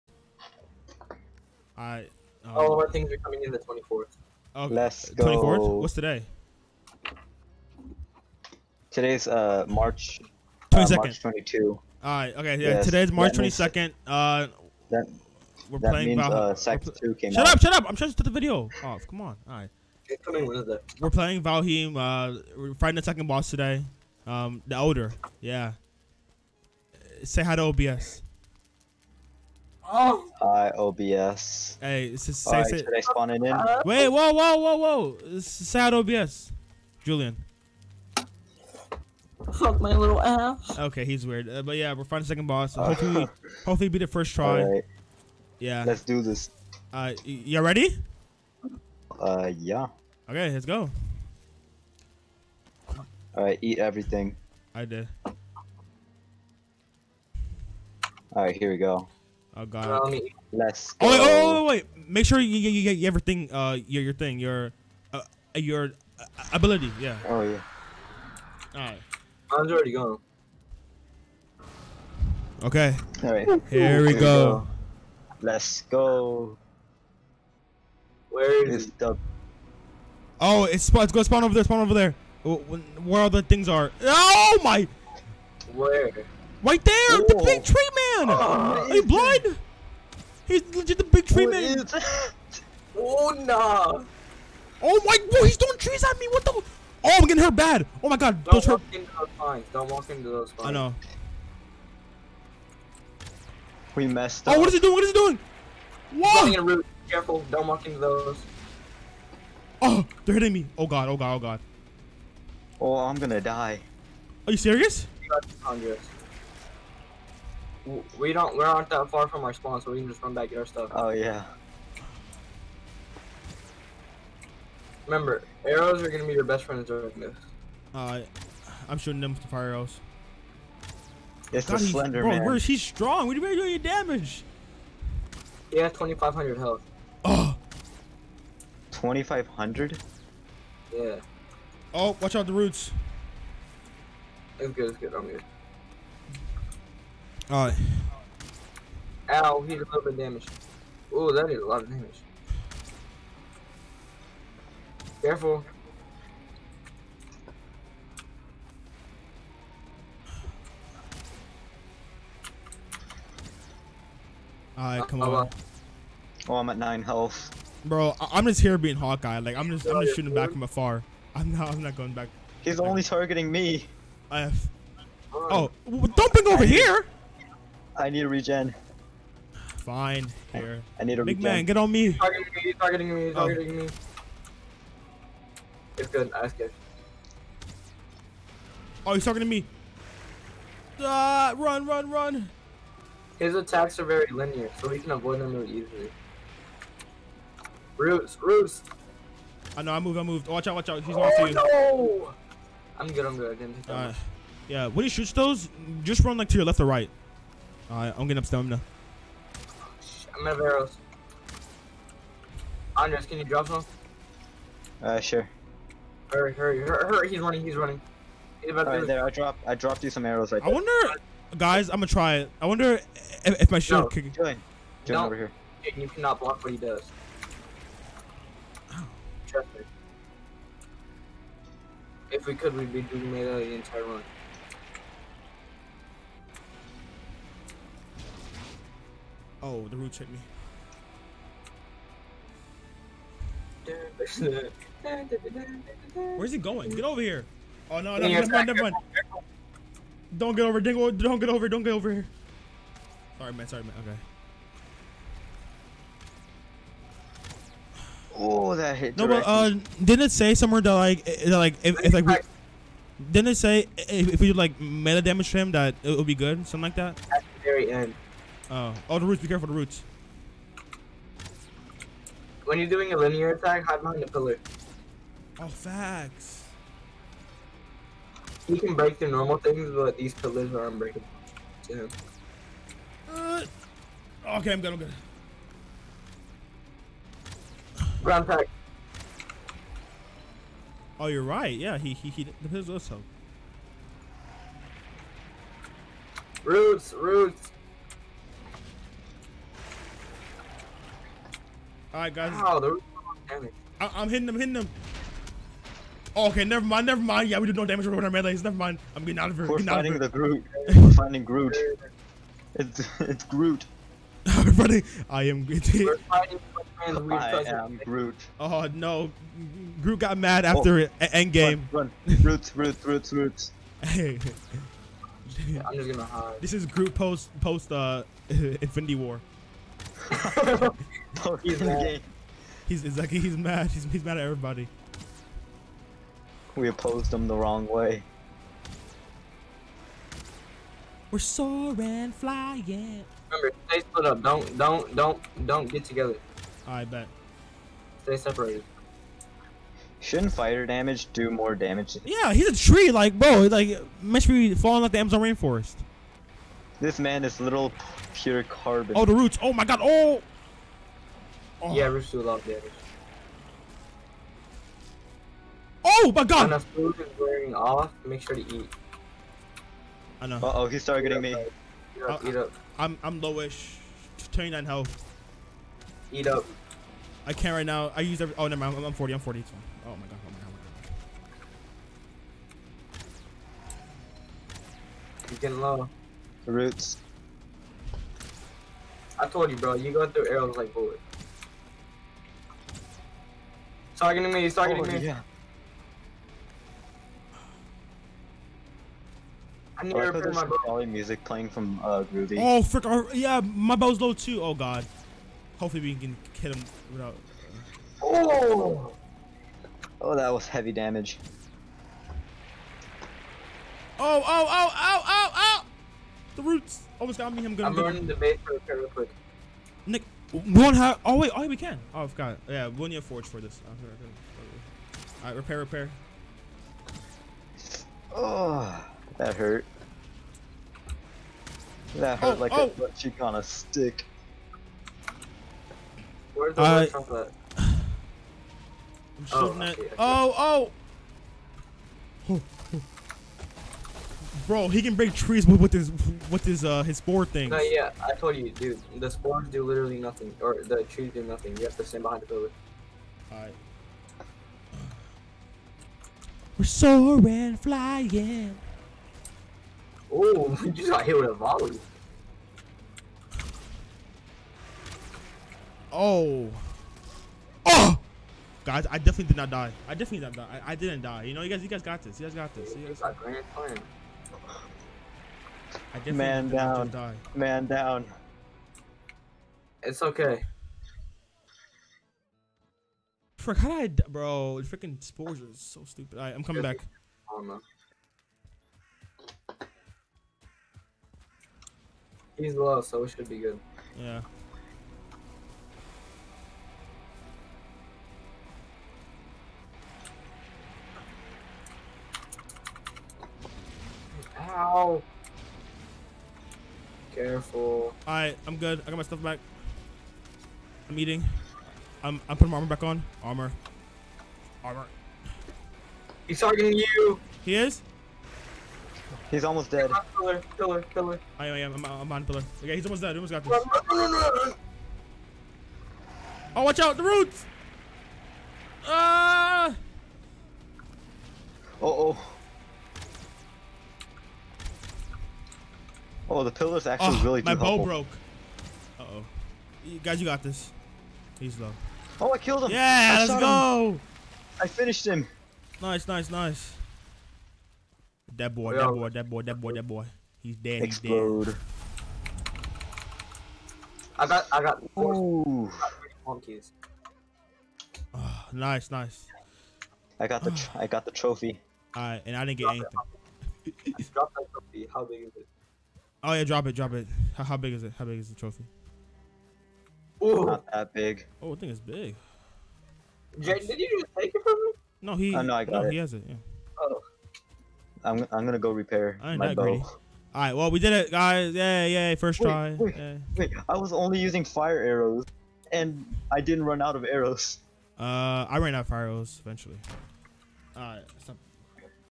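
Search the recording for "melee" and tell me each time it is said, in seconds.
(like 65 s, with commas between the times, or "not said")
233 s, 308 s.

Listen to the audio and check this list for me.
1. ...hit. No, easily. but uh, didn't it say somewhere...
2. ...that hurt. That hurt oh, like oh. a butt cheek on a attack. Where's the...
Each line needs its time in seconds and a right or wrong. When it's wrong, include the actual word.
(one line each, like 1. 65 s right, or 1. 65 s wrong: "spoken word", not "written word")
1. 258 s wrong: "directly", not "easily"
2. 429 s wrong: "stick", not "attack".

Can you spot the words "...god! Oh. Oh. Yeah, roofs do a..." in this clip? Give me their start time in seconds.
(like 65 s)
359 s.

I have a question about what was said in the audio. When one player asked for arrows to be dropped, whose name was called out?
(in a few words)
Andres.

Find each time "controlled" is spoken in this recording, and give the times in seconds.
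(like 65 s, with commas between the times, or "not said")
not said.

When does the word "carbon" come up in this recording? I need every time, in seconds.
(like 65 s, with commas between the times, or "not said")
358 s.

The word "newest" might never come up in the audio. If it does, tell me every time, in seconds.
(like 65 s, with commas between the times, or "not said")
not said.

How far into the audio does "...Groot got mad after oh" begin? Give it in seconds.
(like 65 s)
320 s.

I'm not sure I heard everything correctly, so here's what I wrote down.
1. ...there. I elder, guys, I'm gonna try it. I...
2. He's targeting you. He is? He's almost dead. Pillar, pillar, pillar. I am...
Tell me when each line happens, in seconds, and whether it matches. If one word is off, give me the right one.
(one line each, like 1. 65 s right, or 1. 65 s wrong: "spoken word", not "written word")
1. 220 s wrong: "wonder", not "elder"
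2. 516 s right.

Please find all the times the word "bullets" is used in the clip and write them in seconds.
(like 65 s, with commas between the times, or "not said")
390 s.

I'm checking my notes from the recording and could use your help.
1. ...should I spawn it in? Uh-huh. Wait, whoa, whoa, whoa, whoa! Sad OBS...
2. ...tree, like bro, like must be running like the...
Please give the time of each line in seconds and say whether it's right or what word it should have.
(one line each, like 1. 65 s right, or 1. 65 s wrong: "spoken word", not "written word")
1. 32 s right
2. 352 s wrong: "falling", not "running".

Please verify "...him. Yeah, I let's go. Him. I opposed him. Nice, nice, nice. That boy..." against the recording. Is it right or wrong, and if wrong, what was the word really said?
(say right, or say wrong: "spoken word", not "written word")
wrong: "finished", not "opposed".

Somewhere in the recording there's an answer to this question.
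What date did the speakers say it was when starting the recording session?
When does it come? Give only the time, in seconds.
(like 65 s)
11 s.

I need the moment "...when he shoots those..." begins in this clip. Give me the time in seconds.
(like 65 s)
204 s.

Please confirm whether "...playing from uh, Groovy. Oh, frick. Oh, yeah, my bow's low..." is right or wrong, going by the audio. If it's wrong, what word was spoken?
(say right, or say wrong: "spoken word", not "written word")
right.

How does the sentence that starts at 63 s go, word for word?
Uh, your your thing, your, uh, uh your uh, ability.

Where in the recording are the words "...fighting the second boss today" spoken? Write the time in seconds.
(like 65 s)
22 s.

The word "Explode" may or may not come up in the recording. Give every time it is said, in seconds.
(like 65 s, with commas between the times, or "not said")
551 s.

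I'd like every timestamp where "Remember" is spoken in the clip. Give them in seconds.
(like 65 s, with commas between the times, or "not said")
125 s, 343 s.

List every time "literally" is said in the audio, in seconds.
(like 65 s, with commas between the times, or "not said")
449 s.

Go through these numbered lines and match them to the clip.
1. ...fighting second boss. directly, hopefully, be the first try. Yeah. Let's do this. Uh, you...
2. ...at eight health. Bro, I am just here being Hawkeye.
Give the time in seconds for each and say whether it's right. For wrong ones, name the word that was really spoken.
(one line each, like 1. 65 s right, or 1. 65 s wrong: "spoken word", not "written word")
1. 42 s wrong: "hopefully", not "directly"
2. 166 s wrong: "nine", not "eight".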